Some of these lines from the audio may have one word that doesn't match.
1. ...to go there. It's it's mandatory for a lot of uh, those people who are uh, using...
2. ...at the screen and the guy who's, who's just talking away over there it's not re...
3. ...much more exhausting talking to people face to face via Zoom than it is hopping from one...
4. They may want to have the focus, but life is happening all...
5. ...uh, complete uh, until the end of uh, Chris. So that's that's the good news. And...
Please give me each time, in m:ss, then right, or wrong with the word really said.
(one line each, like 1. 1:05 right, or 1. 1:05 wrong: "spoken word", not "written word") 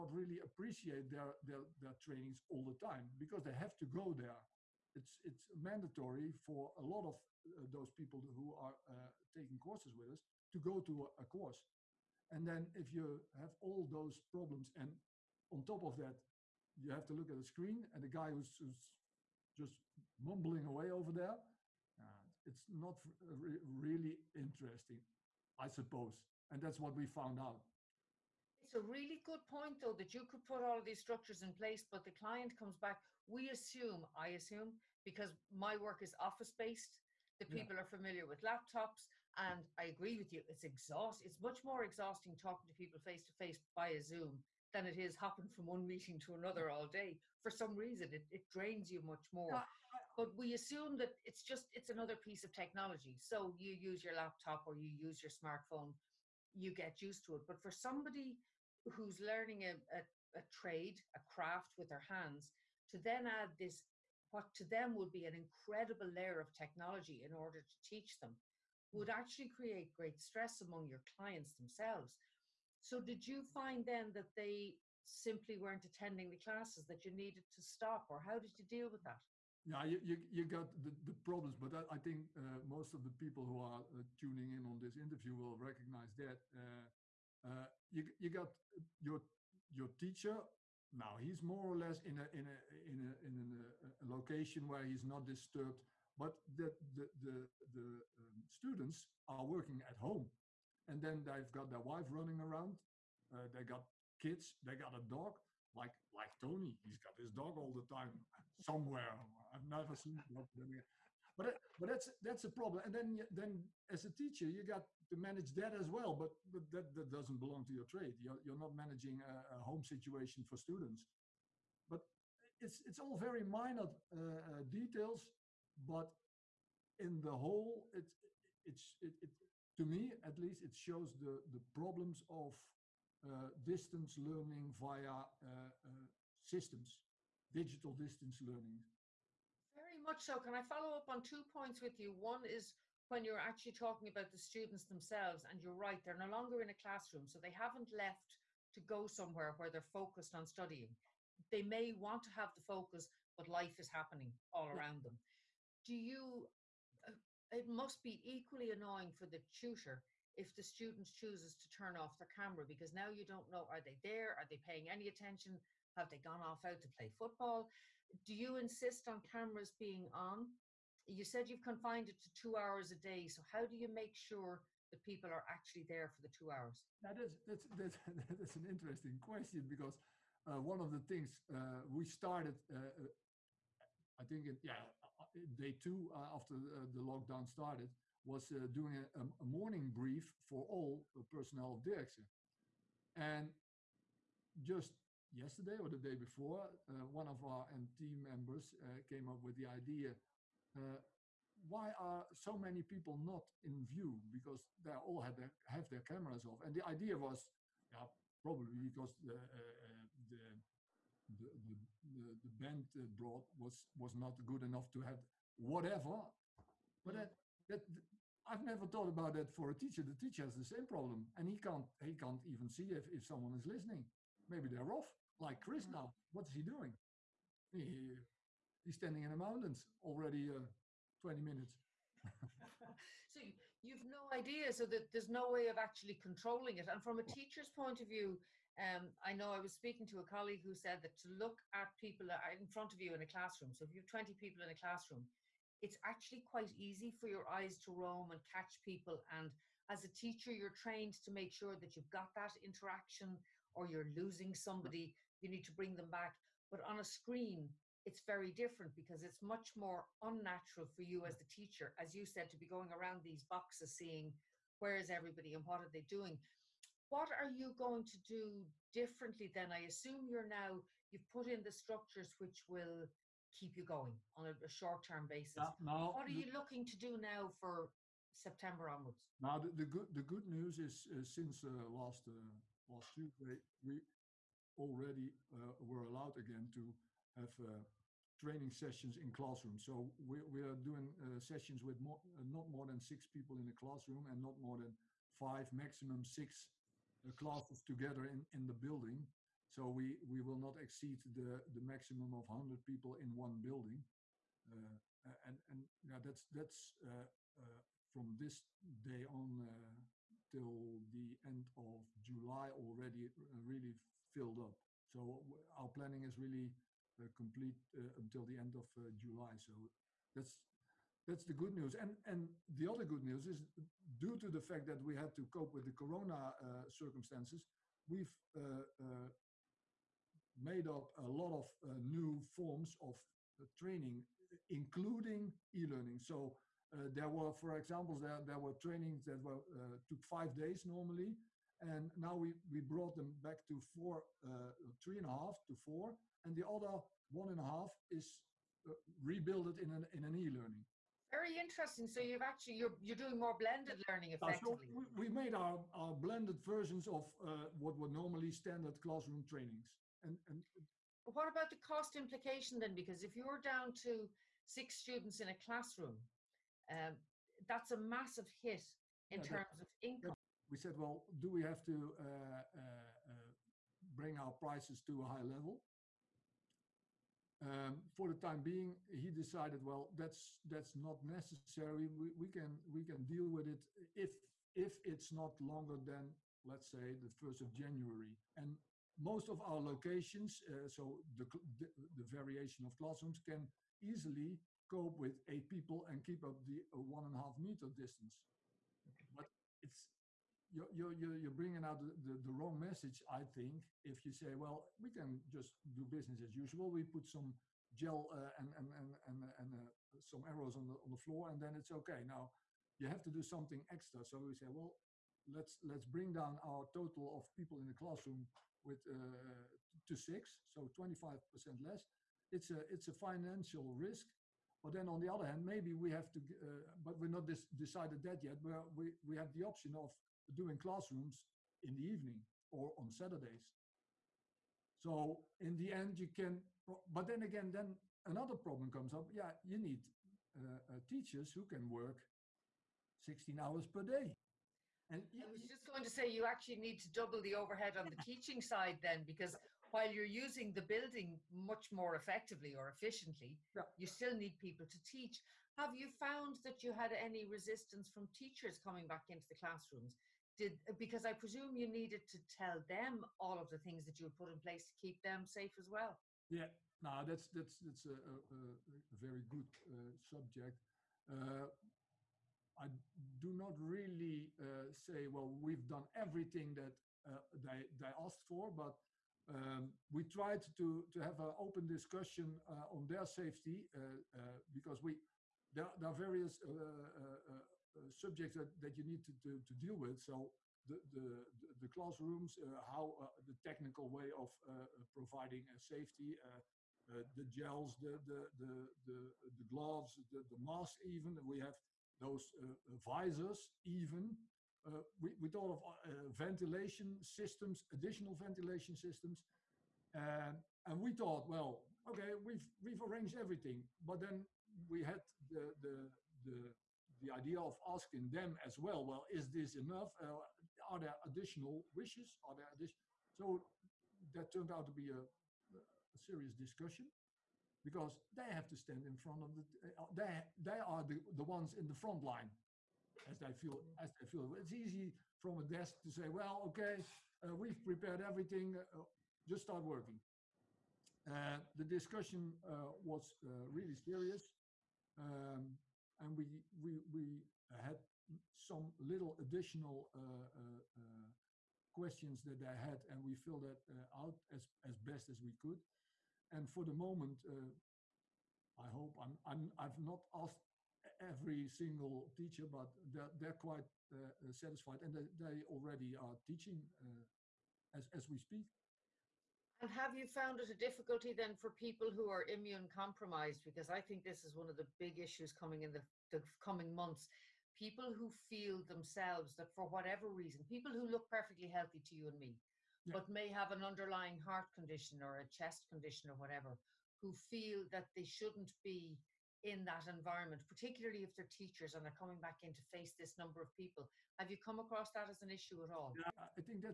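1. 0:03 wrong: "taking", not "using"
2. 0:17 wrong: "mumbling", not "talking"
3. 0:41 right
4. 2:31 right
5. 5:17 wrong: "July", not "Chris".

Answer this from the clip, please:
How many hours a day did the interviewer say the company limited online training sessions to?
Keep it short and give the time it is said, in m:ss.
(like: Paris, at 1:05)
2, at 2:52.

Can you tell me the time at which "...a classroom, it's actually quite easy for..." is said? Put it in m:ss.
4:04.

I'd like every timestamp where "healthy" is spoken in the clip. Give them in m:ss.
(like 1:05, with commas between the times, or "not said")
9:41.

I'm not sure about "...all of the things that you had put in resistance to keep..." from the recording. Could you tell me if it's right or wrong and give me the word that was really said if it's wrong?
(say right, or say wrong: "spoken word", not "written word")
wrong: "place", not "resistance".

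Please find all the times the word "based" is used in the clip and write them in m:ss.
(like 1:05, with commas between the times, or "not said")
0:36.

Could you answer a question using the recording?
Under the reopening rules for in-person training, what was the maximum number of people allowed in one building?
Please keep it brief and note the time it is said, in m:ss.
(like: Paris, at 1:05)
100, at 5:02.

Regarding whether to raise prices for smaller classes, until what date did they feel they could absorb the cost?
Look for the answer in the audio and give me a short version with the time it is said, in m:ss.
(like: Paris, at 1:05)
1 January, at 6:27.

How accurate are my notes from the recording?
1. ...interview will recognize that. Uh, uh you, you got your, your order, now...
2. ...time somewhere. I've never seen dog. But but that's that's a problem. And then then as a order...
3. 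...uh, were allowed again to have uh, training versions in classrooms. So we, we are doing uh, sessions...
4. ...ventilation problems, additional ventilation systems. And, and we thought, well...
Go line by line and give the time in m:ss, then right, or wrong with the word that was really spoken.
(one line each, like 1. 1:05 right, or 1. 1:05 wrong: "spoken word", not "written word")
1. 1:24 wrong: "teacher", not "order"
2. 1:47 wrong: "teacher", not "order"
3. 4:45 wrong: "sessions", not "versions"
4. 8:26 wrong: "systems", not "problems".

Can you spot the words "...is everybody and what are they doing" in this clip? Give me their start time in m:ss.
4:24.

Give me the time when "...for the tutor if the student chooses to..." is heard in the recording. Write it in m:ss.
2:39.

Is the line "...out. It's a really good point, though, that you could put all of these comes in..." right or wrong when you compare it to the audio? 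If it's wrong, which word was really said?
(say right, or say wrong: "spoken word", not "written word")
wrong: "structures", not "comes".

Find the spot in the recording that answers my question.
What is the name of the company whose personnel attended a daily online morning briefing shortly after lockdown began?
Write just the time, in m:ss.
3:11.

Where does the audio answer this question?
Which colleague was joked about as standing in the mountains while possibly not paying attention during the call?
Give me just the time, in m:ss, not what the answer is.
3:45.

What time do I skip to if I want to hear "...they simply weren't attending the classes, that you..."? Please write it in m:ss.
1:14.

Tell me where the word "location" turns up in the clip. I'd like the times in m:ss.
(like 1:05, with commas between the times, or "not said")
1:34, 6:29.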